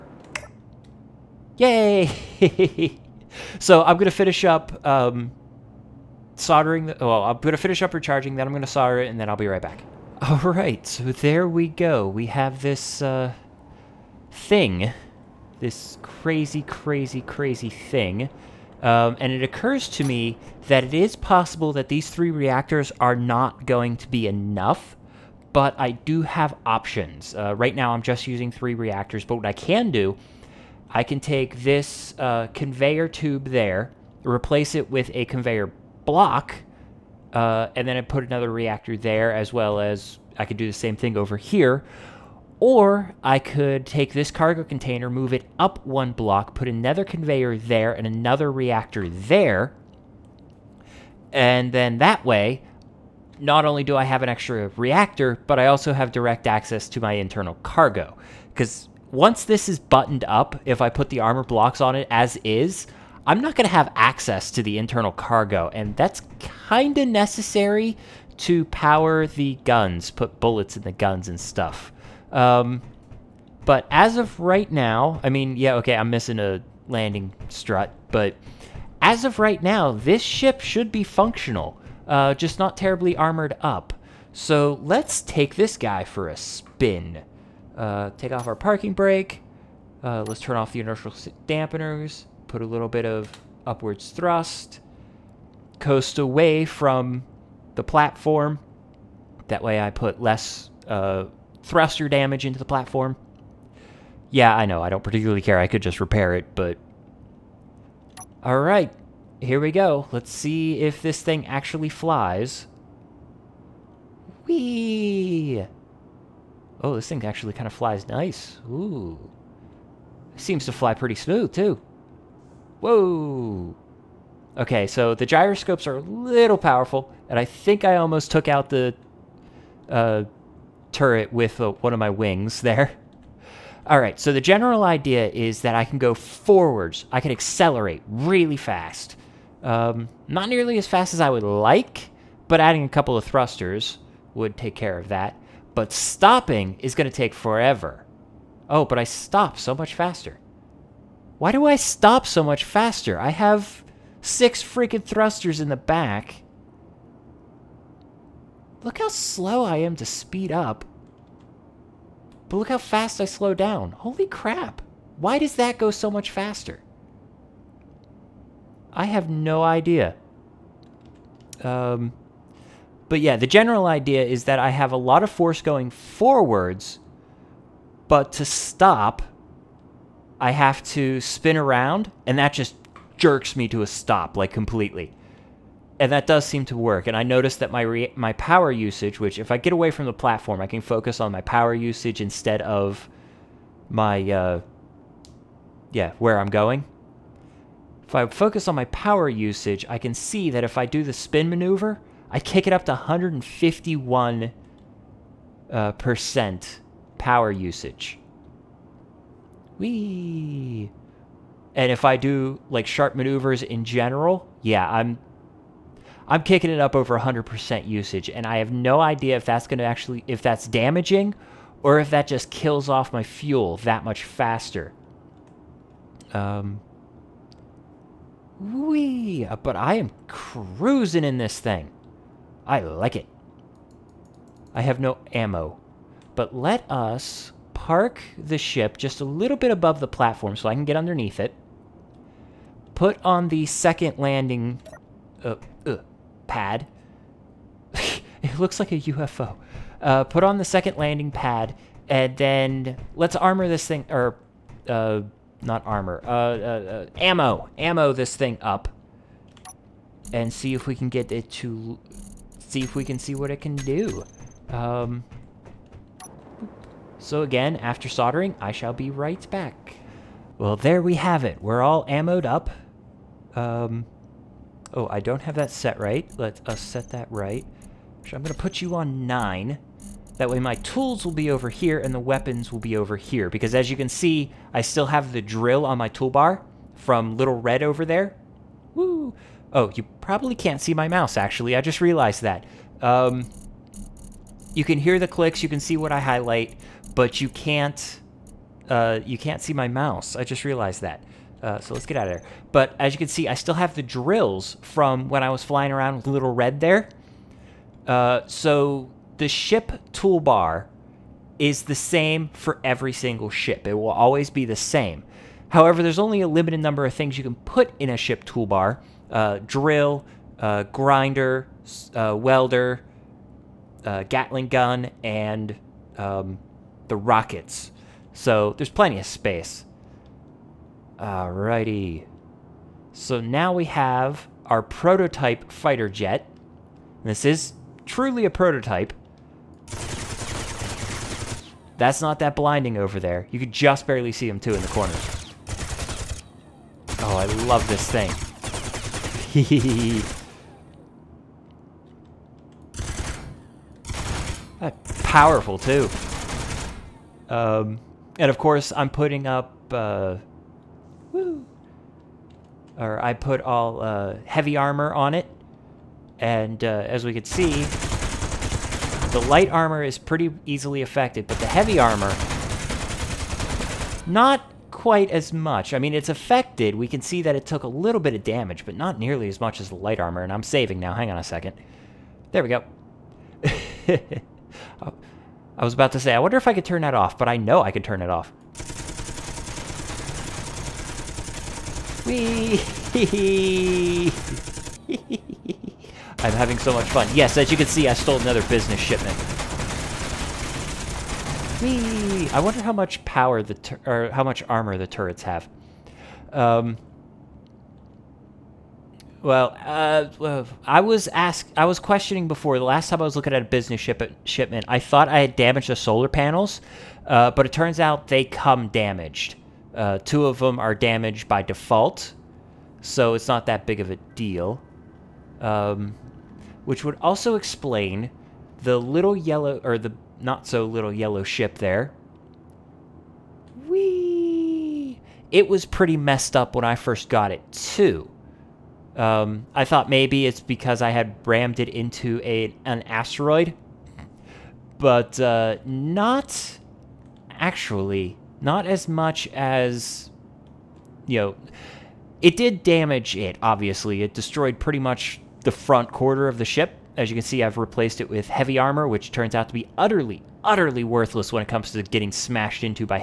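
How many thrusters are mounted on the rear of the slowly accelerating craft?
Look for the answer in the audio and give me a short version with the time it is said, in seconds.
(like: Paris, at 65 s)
6, at 154 s.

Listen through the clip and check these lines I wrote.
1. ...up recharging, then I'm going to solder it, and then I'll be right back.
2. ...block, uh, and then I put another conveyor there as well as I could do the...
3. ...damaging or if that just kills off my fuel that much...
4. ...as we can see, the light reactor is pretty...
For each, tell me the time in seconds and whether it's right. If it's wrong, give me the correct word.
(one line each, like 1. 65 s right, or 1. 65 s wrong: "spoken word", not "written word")
1. 7 s right
2. 36 s wrong: "reactor", not "conveyor"
3. 220 s right
4. 366 s wrong: "armor", not "reactor".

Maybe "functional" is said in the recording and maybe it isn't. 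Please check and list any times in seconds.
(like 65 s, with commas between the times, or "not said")
81 s.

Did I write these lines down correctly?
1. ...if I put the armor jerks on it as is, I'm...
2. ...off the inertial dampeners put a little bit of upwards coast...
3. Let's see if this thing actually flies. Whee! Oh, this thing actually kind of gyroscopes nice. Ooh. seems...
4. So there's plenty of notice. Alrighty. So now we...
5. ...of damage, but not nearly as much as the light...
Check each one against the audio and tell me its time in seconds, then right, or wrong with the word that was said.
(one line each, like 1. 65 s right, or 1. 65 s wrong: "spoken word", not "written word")
1. 60 s wrong: "blocks", not "jerks"
2. 90 s wrong: "thrust", not "coast"
3. 110 s wrong: "flies", not "gyroscopes"
4. 328 s wrong: "space", not "notice"
5. 378 s right.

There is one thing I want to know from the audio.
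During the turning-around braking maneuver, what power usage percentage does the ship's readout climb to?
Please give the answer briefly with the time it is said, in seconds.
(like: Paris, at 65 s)
151%, at 202 s.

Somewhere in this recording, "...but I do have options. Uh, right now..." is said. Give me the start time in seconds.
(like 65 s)
25 s.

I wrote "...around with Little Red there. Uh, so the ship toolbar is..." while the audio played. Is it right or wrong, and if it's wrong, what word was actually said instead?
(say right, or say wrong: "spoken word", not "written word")
right.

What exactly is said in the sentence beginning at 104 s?
Yeah, I know, I don't particularly care.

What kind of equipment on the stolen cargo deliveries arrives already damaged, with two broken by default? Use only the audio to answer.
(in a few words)
Solar panels.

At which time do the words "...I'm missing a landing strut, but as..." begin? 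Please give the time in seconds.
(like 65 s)
75 s.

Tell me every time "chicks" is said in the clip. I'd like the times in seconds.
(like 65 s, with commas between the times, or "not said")
not said.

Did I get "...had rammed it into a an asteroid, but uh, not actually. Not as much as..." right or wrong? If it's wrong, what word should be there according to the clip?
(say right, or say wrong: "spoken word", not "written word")
right.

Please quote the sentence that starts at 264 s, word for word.
Um, so again, after soldering, I shall be right back.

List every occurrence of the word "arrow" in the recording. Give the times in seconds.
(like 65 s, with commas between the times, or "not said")
not said.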